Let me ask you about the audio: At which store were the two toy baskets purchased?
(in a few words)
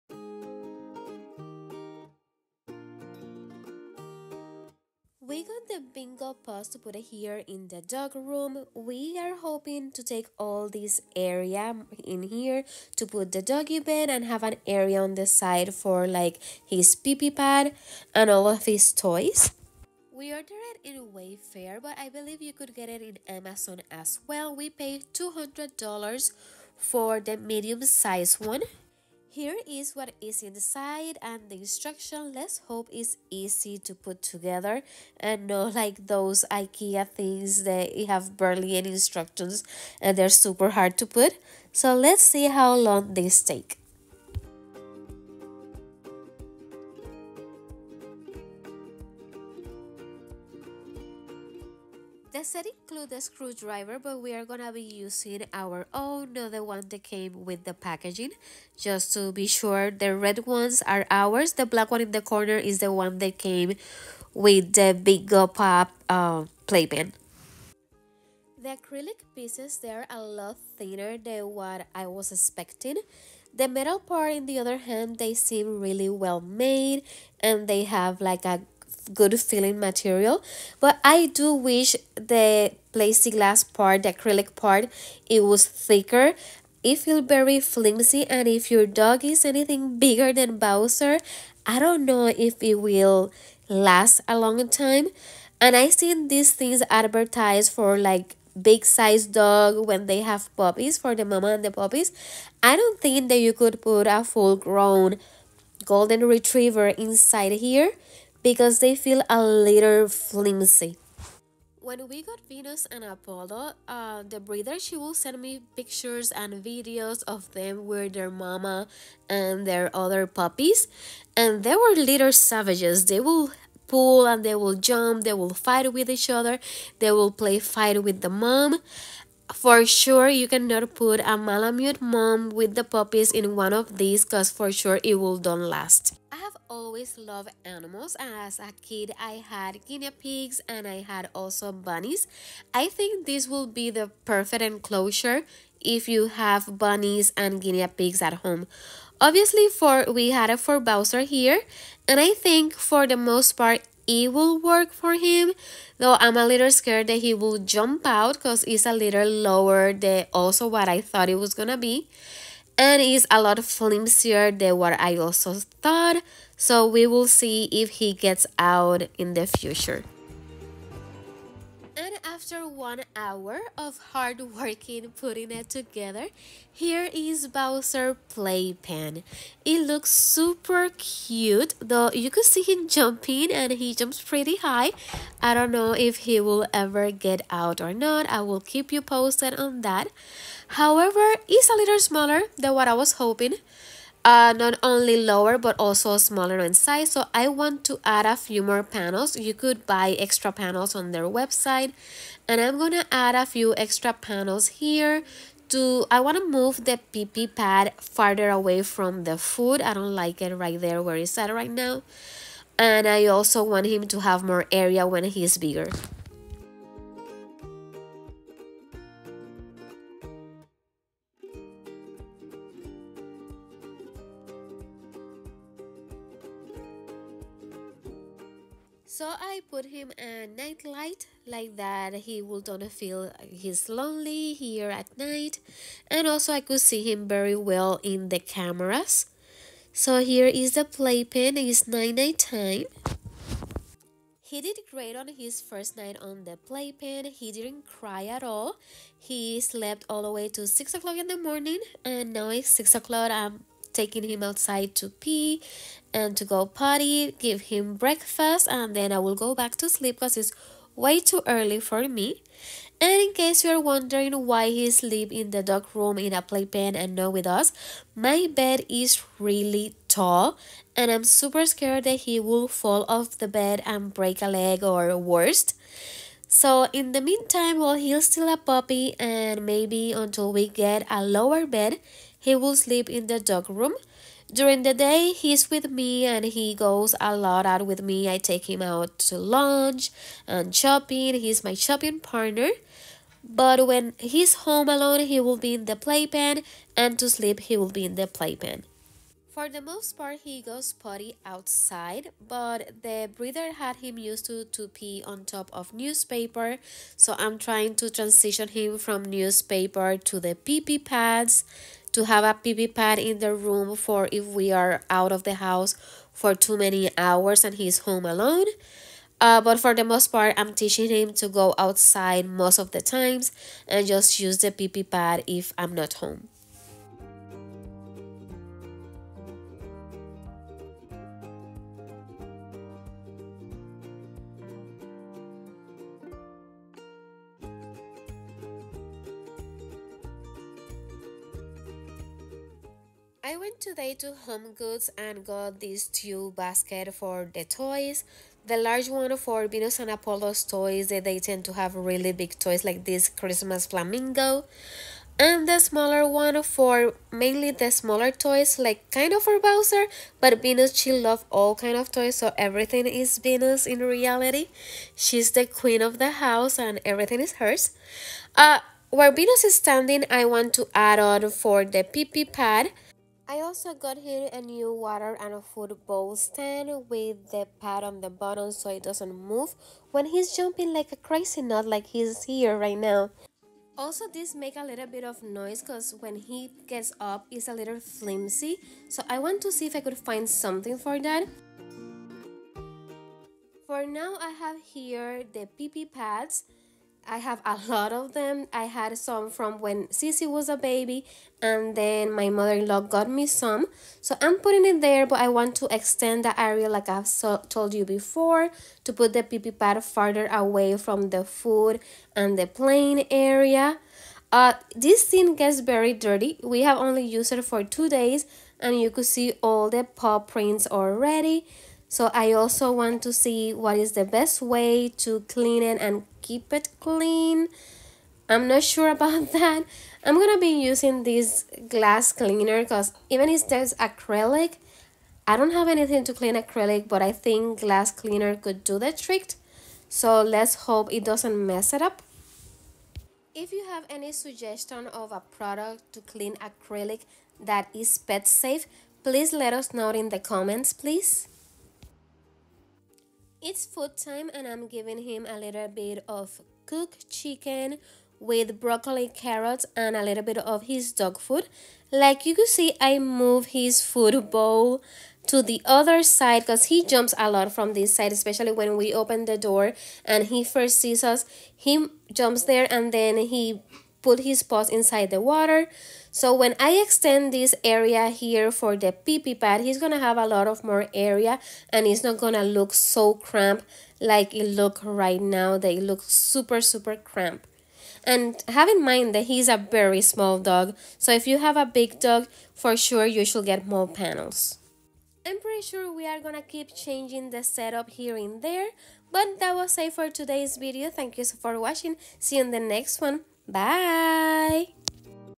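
Home Goods.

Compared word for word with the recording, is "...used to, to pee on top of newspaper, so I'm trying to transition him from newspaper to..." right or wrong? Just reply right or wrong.
right.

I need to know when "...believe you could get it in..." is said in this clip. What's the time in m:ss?
0:22.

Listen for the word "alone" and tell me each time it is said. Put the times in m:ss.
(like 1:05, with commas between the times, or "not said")
4:54, 5:18.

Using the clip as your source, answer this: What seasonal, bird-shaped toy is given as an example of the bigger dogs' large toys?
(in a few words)
Christmas flamingo.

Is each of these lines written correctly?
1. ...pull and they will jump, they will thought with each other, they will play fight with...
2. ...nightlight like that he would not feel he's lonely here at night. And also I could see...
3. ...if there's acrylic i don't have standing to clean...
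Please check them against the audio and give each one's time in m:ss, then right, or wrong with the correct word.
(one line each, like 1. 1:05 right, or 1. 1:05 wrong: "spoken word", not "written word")
1. 2:03 wrong: "fight", not "thought"
2. 3:50 right
3. 7:13 wrong: "anything", not "standing".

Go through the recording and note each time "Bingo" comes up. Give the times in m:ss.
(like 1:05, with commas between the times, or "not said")
0:05, 1:04.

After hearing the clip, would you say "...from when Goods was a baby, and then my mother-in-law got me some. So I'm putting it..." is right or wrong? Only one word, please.
wrong.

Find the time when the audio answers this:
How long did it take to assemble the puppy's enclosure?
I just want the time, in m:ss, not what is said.
2:52.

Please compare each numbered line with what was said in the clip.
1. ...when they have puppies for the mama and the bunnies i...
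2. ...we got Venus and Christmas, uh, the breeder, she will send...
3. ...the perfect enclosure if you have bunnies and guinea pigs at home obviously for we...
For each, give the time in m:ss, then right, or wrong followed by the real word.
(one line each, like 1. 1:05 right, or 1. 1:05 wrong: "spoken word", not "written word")
1. 1:39 wrong: "puppies", not "bunnies"
2. 1:52 wrong: "Apollo", not "Christmas"
3. 2:23 right.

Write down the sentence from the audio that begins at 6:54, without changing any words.
Uh, this thing gets very dirty.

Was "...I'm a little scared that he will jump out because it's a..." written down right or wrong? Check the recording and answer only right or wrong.
right.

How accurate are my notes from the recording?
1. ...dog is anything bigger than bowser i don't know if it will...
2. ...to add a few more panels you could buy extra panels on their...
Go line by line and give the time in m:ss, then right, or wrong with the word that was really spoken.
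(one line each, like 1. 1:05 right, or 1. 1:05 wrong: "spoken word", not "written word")
1. 1:28 right
2. 3:17 right.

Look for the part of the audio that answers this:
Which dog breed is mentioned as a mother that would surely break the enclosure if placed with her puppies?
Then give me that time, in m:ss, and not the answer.
2:11.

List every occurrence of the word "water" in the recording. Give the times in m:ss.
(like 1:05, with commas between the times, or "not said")
6:14, 7:55.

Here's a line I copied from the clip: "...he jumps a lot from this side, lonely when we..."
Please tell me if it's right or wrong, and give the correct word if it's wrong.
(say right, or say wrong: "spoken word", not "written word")
wrong: "especially", not "lonely".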